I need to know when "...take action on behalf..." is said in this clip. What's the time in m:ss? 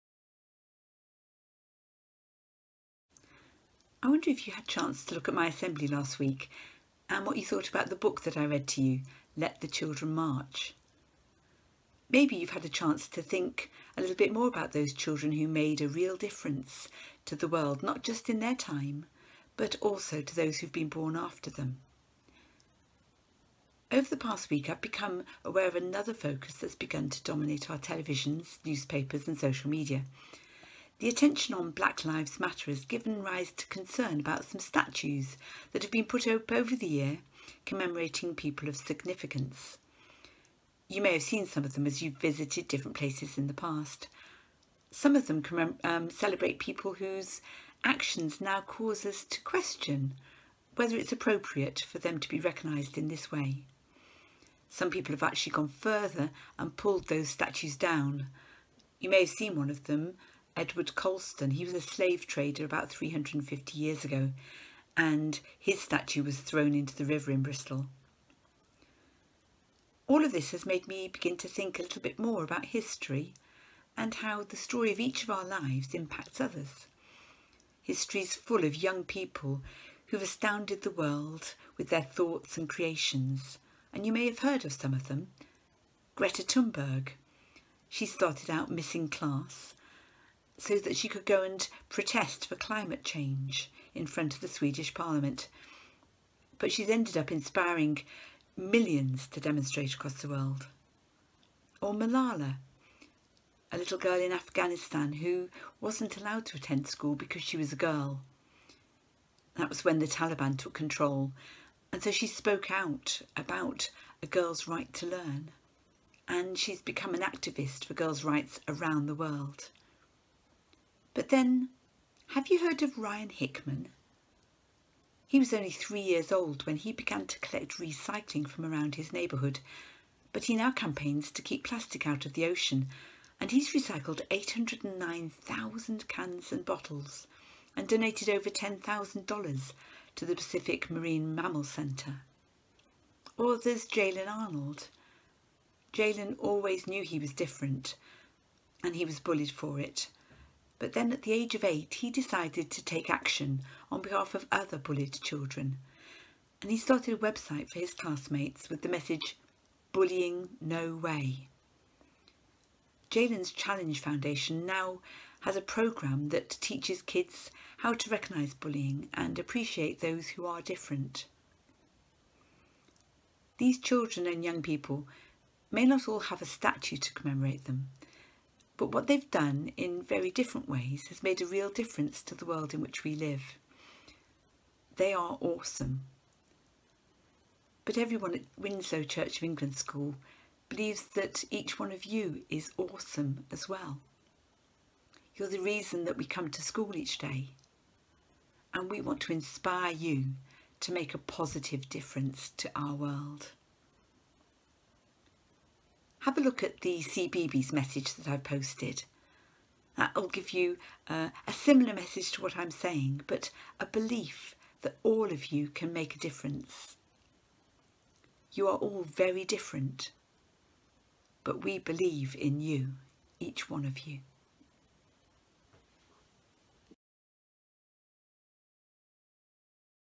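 2:32.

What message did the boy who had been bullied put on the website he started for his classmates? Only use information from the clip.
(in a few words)
Bullying No Way.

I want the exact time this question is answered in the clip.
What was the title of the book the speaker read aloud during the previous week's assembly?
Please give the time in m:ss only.
0:09.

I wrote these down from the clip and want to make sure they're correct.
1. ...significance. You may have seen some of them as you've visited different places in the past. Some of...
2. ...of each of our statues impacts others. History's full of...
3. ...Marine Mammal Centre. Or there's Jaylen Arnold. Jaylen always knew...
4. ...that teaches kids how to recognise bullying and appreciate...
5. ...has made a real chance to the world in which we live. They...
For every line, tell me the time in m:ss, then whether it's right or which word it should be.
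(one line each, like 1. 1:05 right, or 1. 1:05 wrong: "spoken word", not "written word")
1. 0:38 right
2. 1:14 wrong: "lives", not "statues"
3. 2:20 right
4. 2:46 right
5. 3:01 wrong: "difference", not "chance".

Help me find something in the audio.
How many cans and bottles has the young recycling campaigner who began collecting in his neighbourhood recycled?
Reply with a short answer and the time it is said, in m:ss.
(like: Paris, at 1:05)
809,000, at 2:14.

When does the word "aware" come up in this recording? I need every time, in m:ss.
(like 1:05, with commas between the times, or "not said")
0:25.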